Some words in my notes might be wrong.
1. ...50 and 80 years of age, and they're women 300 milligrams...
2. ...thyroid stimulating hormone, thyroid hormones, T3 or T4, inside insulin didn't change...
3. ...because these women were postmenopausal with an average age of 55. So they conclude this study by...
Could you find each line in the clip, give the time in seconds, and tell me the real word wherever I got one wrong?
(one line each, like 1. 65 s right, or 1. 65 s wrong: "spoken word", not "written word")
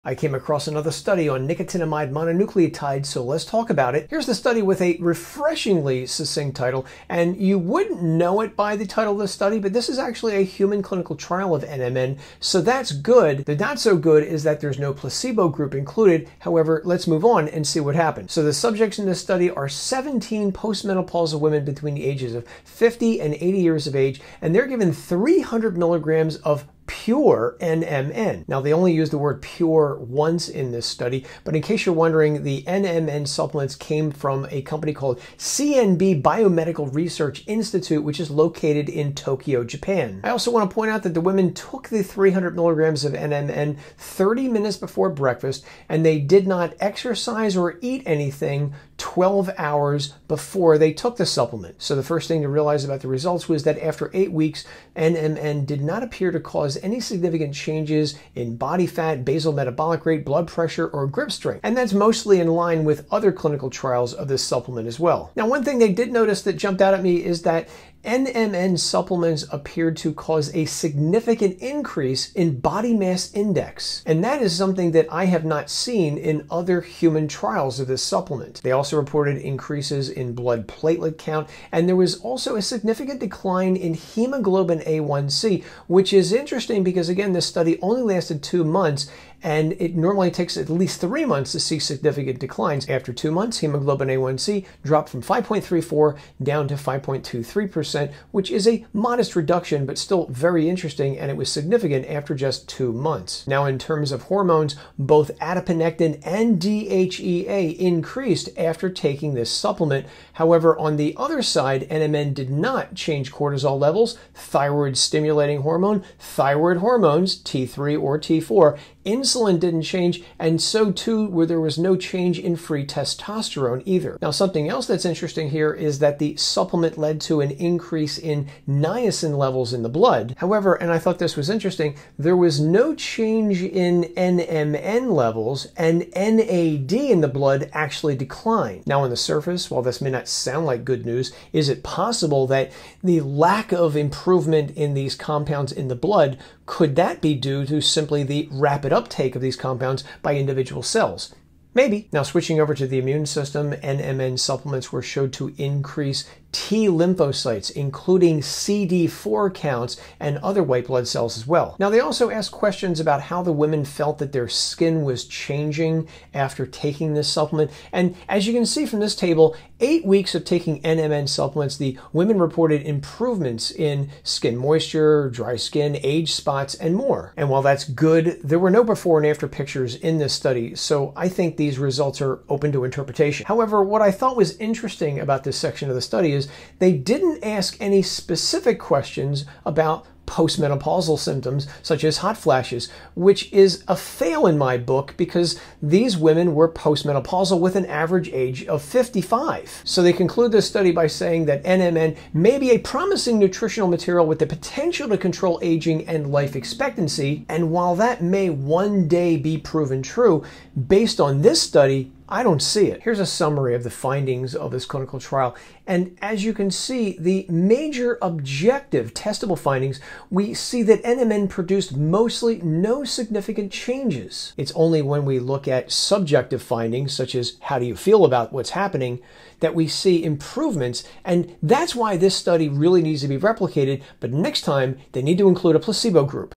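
1. 22 s wrong: "given", not "women"
2. 114 s right
3. 195 s right.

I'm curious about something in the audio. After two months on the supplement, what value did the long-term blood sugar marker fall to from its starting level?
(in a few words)
5.23%.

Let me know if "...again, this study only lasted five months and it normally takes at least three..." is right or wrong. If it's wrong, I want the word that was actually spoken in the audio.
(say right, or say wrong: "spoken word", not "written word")
wrong: "two", not "five".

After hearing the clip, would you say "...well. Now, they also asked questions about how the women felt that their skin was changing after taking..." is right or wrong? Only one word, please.
right.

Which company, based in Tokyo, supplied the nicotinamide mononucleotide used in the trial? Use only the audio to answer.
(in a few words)
CNB Biomedical Research Institute.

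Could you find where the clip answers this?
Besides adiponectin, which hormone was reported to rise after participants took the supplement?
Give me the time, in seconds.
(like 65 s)
106 s.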